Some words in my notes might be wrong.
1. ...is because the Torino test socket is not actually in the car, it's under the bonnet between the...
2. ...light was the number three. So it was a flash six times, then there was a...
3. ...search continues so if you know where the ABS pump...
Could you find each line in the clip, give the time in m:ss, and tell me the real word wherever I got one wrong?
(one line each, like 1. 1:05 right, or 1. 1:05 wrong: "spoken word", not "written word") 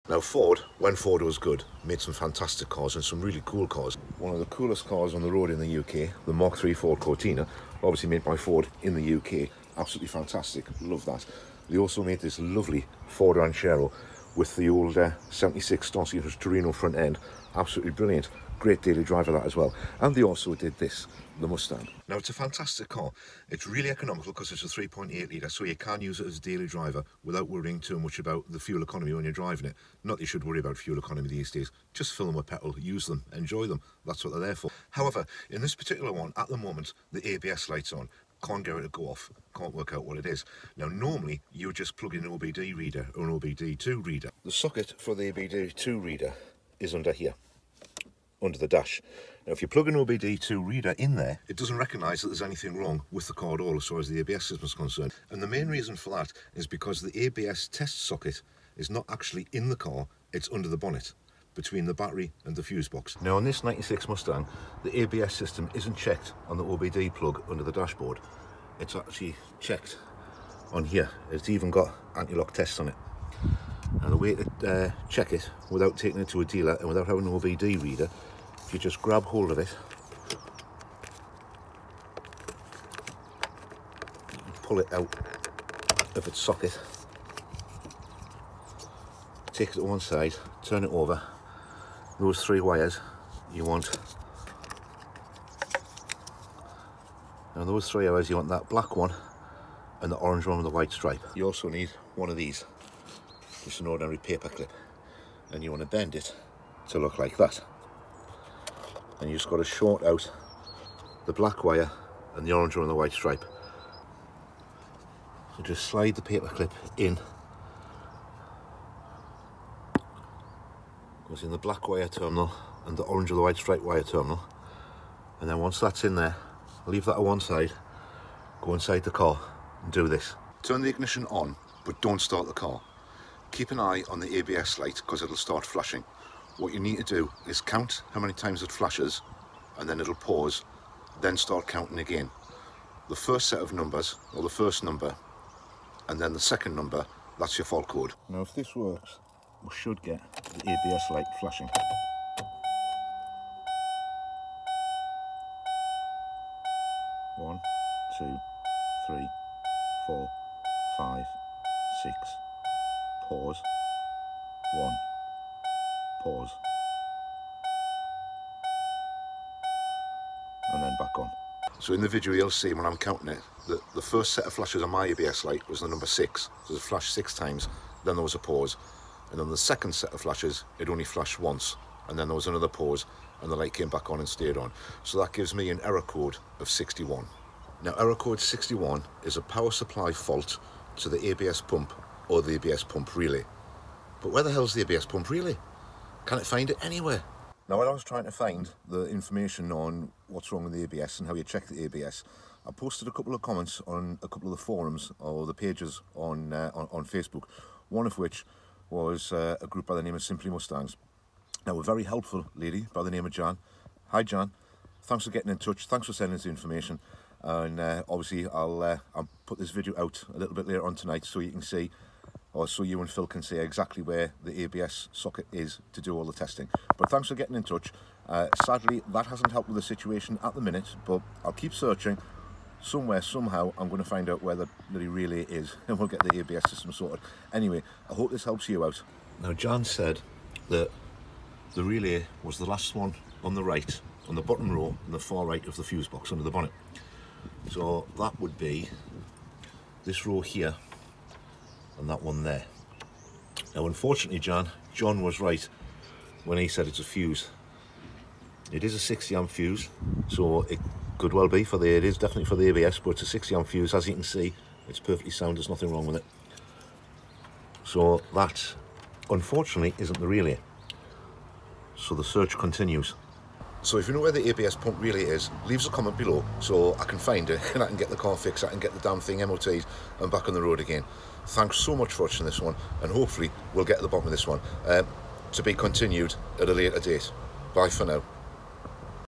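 1. 0:56 wrong: "ABS", not "Torino"
2. 2:55 wrong: "six", not "three"
3. 4:32 right.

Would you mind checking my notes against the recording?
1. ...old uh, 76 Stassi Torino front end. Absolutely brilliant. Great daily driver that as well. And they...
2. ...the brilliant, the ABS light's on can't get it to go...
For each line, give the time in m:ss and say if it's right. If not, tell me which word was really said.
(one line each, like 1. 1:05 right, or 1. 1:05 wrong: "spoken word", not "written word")
1. 0:14 right
2. 0:36 wrong: "moment", not "brilliant".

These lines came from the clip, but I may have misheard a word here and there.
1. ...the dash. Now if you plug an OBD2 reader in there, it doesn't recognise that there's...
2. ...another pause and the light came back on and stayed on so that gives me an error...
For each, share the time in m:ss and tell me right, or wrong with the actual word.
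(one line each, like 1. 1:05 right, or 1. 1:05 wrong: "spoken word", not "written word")
1. 0:48 right
2. 3:02 right.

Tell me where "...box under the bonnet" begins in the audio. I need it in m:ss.
4:06.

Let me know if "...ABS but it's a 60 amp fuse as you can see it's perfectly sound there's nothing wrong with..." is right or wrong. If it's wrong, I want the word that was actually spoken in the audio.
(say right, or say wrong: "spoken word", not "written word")
right.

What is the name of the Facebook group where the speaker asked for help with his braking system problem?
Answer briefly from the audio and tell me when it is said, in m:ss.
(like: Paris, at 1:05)
Simply Mustangs, at 3:30.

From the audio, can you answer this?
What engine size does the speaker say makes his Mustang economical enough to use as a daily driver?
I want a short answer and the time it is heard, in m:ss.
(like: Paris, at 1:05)
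3.8 litre, at 0:24.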